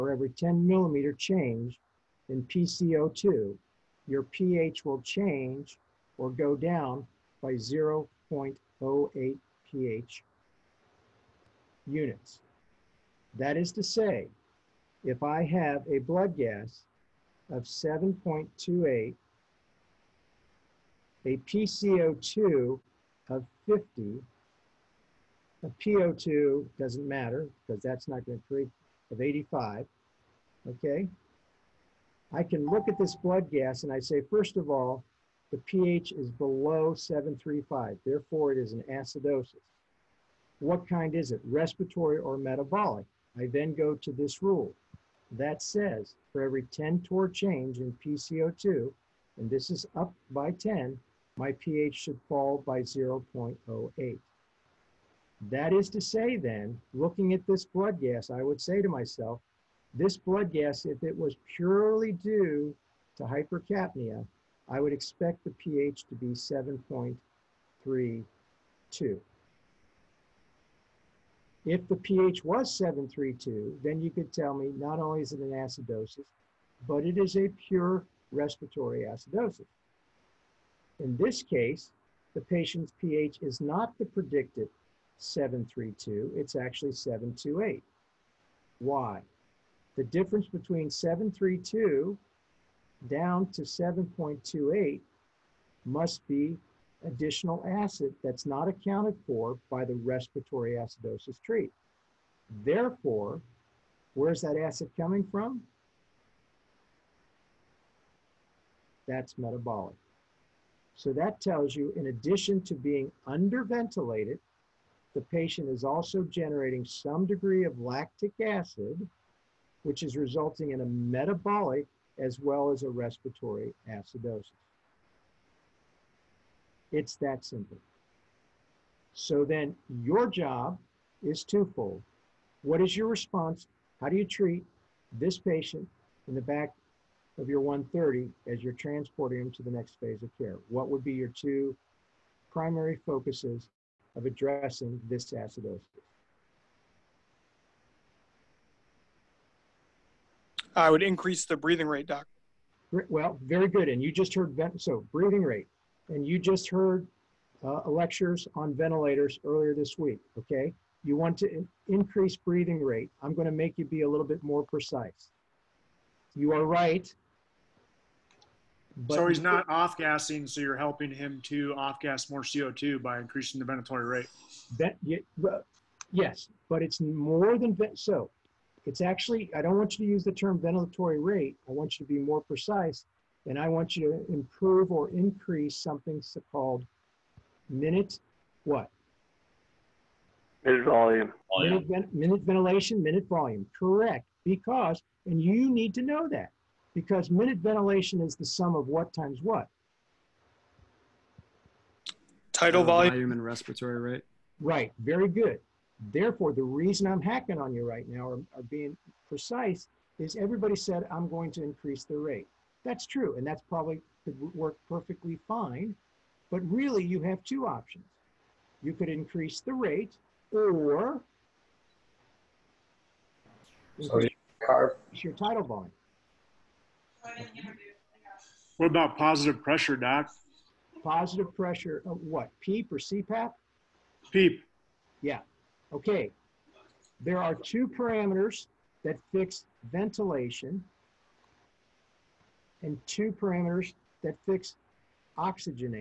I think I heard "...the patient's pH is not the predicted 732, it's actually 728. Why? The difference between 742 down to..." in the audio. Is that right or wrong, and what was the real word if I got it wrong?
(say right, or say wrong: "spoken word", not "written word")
wrong: "732", not "742".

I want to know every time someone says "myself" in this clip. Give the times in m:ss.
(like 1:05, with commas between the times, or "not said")
0:58.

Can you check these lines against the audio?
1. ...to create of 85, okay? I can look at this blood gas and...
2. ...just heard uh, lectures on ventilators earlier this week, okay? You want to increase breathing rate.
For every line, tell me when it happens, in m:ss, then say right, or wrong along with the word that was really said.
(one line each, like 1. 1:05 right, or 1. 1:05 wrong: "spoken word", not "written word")
1. 0:28 right
2. 2:36 right.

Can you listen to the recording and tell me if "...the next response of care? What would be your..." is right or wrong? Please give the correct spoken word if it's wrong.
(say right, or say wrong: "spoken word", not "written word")
wrong: "phase", not "response".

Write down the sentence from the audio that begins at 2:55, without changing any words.
yeah, well, yes, but it's more than, so it's actually, I don't want you to use the term ventilatory rate.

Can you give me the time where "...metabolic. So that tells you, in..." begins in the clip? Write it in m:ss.
1:49.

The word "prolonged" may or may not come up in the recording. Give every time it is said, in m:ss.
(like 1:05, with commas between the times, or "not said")
not said.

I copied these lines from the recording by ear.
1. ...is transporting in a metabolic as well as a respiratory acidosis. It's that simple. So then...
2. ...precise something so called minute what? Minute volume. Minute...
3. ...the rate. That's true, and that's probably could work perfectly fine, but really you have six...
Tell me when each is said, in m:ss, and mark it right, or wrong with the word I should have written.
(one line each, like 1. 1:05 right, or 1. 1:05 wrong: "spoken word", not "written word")
1. 2:00 wrong: "resulting", not "transporting"
2. 3:05 wrong: "increase", not "precise"
3. 3:32 wrong: "two", not "six".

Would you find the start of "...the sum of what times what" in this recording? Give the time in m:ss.
3:18.